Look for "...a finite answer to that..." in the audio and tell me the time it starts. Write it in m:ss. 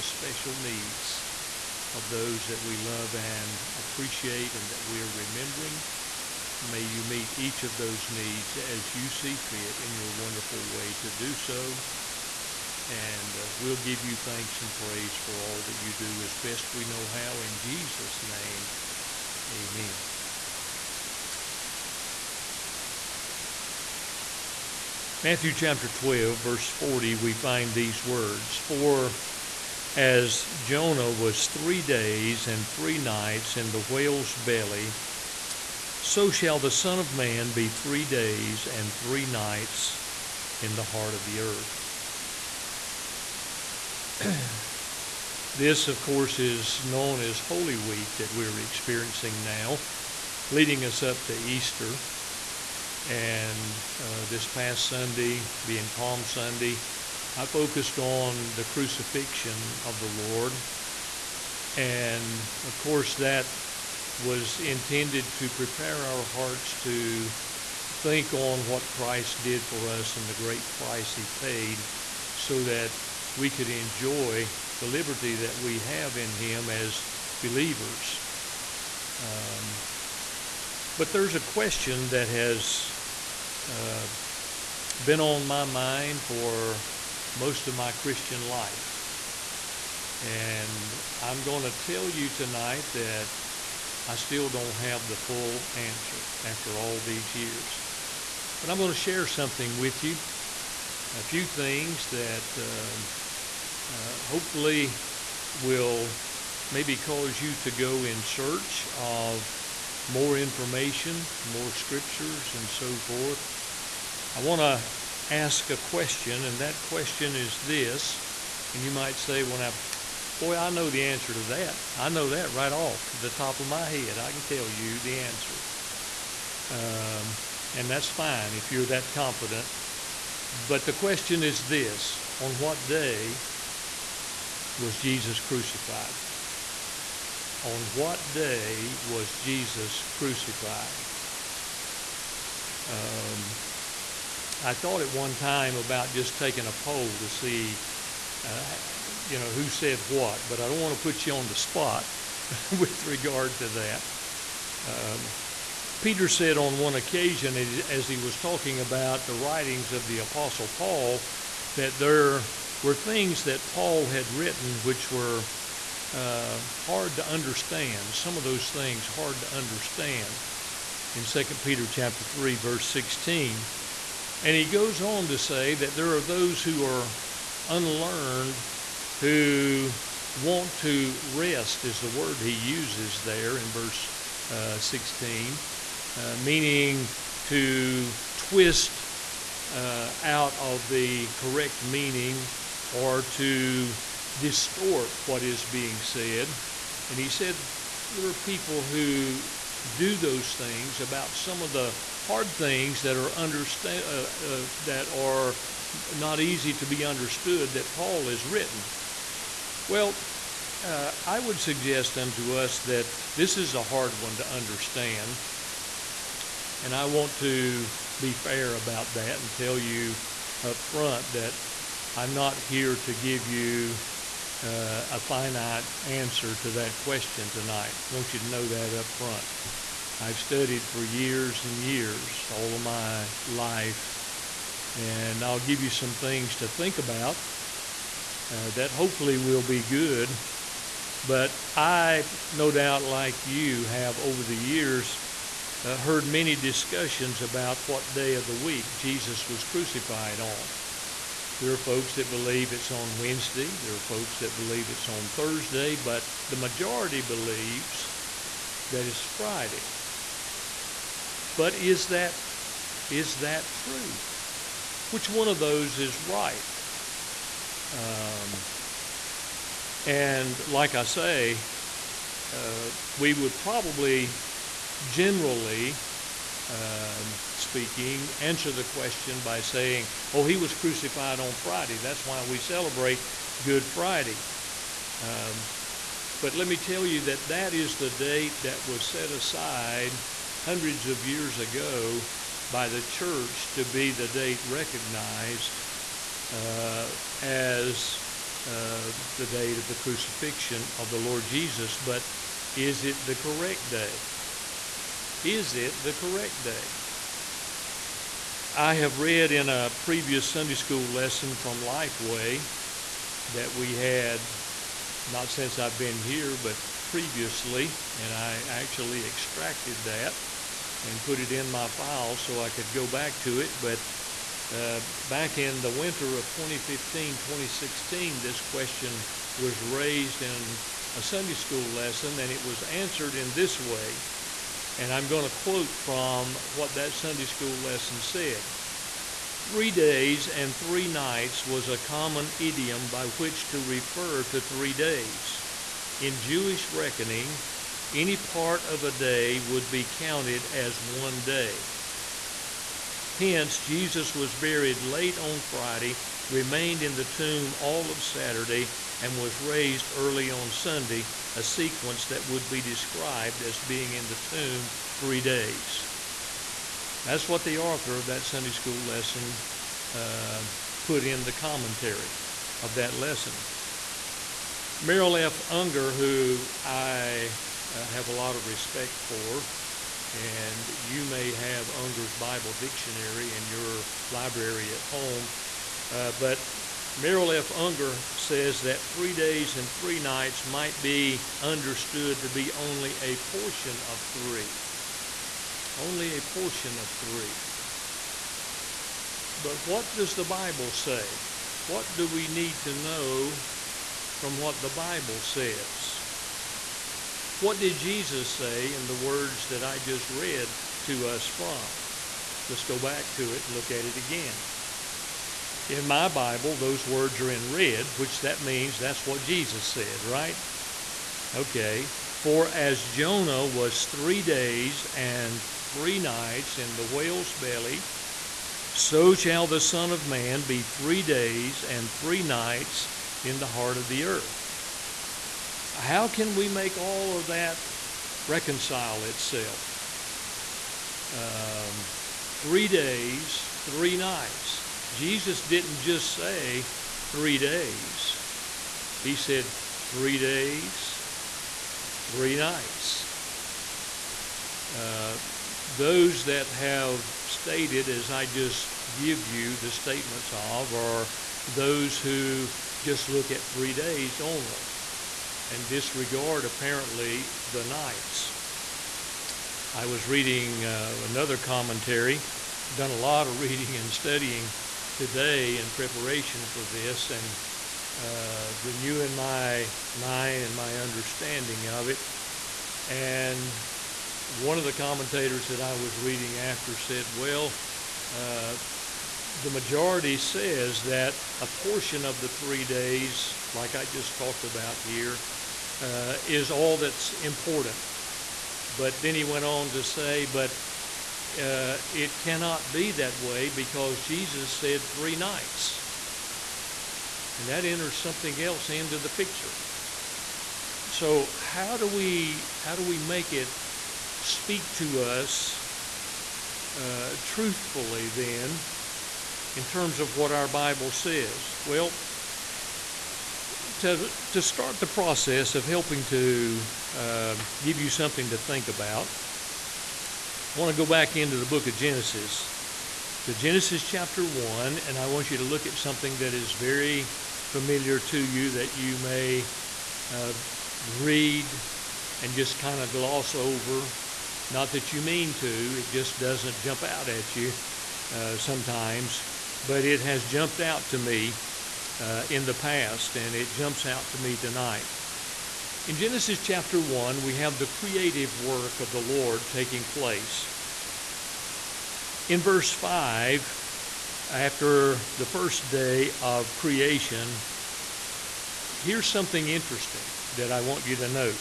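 3:45.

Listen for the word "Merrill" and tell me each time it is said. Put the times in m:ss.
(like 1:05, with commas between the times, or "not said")
6:14, 6:27.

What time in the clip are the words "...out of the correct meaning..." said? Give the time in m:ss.
3:10.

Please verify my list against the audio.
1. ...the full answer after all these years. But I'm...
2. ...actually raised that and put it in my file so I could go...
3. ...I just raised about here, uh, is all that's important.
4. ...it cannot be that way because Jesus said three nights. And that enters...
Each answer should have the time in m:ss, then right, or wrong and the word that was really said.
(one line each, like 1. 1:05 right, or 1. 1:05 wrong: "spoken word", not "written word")
1. 1:35 right
2. 5:18 wrong: "extracted", not "raised"
3. 8:13 wrong: "talked", not "raised"
4. 8:22 right.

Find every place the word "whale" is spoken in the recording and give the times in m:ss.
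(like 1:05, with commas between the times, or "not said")
0:33, 7:07.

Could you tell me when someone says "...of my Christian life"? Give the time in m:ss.
1:27.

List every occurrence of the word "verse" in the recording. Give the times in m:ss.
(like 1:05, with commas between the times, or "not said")
0:26, 2:52, 3:03, 9:22.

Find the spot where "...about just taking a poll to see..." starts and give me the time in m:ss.
2:25.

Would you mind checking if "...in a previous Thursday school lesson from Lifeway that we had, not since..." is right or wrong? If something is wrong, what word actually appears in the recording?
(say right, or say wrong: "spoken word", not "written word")
wrong: "Sunday", not "Thursday".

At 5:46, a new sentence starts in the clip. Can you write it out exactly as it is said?
In Jewish reckoning, any part of a day would be counted as one day.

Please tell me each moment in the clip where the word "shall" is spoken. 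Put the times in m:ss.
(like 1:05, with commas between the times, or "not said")
0:36, 7:09.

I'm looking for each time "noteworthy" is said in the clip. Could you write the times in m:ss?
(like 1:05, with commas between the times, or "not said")
not said.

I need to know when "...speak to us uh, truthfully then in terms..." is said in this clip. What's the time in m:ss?
8:34.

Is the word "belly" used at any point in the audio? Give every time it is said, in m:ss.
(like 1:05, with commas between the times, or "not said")
0:34, 7:07.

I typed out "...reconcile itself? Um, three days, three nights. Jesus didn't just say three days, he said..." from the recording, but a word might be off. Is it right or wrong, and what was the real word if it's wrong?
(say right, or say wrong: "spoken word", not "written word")
right.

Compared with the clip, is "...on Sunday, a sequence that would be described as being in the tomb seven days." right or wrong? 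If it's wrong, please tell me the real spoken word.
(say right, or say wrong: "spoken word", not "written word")
wrong: "three", not "seven".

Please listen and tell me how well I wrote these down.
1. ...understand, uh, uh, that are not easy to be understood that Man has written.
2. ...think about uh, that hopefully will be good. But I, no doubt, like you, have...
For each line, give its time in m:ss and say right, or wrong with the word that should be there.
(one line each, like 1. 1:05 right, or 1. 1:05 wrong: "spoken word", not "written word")
1. 3:23 wrong: "Paul", not "Man"
2. 3:56 right.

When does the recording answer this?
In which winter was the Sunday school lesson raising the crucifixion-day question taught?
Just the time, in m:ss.
5:26.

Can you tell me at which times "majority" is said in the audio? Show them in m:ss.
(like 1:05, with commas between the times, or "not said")
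4:16, 8:09.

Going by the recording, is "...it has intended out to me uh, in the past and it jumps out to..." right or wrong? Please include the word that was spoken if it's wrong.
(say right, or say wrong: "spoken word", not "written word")
wrong: "jumped", not "intended".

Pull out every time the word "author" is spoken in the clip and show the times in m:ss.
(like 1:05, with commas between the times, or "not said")
6:07.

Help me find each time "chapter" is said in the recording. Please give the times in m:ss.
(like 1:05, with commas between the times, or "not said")
0:25, 2:51, 8:54, 9:16.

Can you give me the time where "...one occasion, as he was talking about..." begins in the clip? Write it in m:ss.
2:36.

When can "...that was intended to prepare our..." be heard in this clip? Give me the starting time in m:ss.
1:03.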